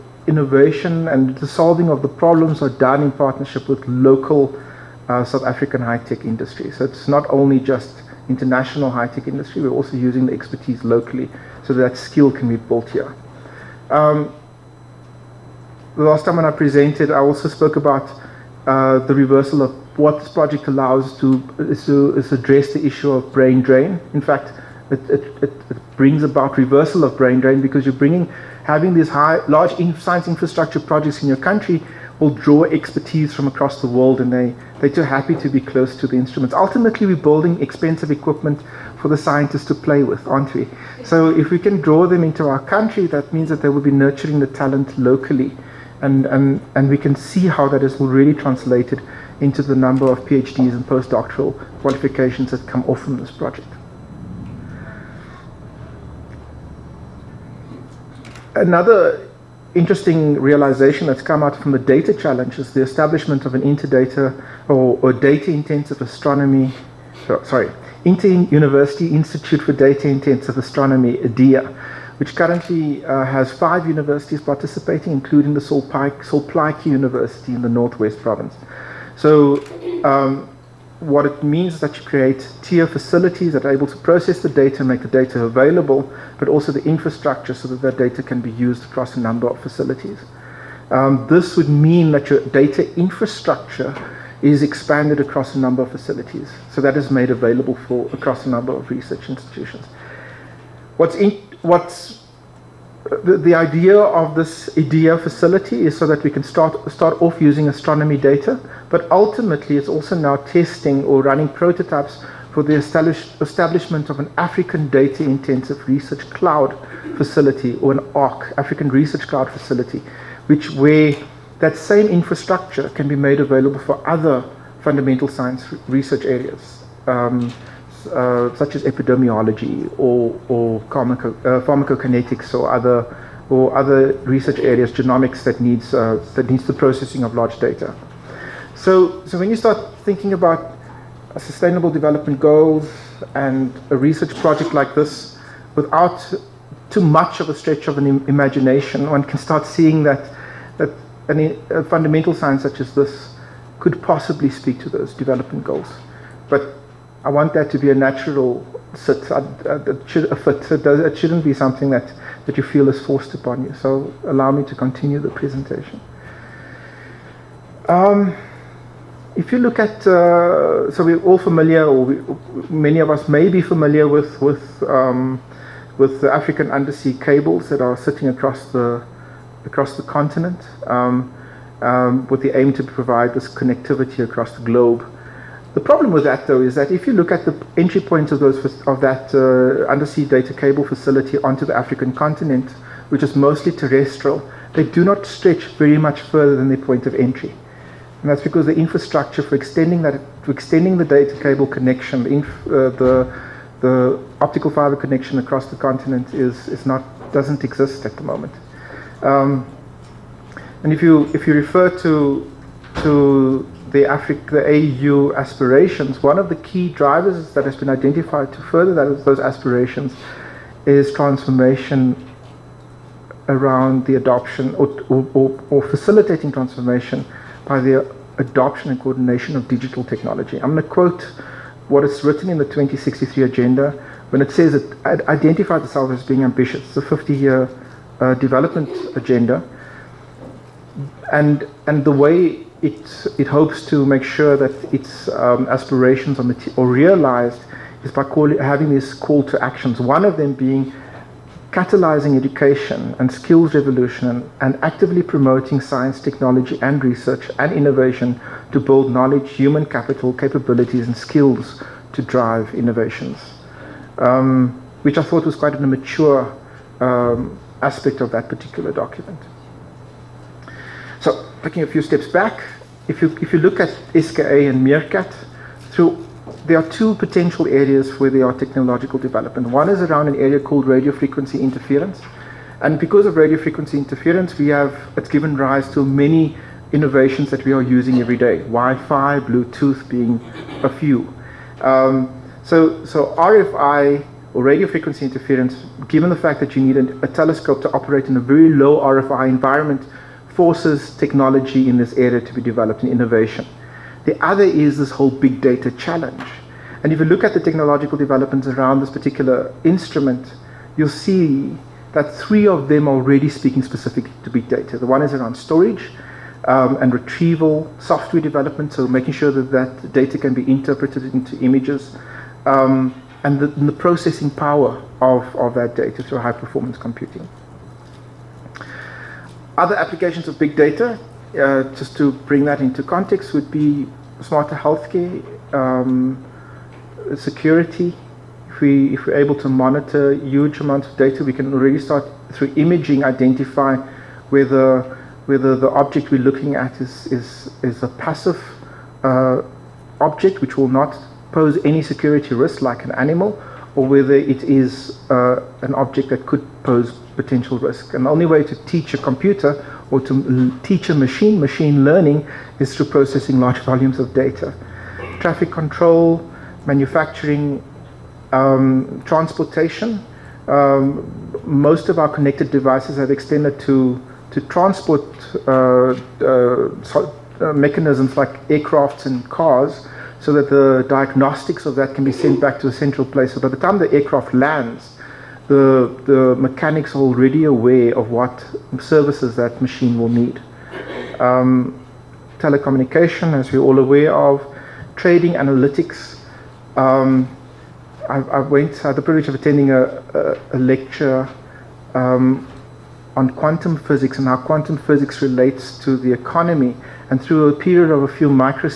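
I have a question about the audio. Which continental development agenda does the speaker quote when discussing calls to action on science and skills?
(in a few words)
2063 agenda.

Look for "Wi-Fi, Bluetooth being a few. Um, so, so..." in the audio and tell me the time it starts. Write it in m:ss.
4:48.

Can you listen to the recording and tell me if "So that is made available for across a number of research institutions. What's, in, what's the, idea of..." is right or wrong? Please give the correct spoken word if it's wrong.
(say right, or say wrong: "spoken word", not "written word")
right.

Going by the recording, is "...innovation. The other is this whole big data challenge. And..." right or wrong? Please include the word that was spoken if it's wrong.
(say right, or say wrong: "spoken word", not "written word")
right.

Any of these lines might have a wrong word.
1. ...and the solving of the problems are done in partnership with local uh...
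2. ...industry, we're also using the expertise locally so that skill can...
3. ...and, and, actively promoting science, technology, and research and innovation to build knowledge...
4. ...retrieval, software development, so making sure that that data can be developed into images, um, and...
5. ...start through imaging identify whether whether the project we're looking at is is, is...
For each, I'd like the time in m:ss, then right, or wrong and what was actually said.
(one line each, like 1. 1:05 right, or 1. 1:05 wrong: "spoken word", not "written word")
1. 0:01 right
2. 0:09 right
3. 4:14 right
4. 5:17 wrong: "interpreted", not "developed"
5. 5:41 wrong: "object", not "project".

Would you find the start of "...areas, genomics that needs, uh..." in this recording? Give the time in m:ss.
2:14.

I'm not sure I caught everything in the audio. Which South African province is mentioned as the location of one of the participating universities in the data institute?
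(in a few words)
Northwest Province.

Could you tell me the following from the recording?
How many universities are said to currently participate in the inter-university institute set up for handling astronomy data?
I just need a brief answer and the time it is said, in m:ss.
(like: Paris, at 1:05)
5, at 1:13.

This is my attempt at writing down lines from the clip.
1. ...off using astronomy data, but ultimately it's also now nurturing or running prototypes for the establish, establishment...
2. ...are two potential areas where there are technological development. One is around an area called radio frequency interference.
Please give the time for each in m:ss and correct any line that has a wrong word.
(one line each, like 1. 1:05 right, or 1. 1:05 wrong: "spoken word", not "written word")
1. 1:47 wrong: "testing", not "nurturing"
2. 4:36 right.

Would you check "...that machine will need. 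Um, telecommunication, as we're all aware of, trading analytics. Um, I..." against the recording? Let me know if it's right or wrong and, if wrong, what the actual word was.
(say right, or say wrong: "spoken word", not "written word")
right.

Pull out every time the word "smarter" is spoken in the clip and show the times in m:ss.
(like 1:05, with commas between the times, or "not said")
5:34.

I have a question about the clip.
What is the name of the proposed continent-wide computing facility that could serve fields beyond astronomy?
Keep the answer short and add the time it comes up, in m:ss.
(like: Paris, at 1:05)
African Research Cloud, at 1:58.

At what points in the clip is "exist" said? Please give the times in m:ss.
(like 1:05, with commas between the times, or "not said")
3:27.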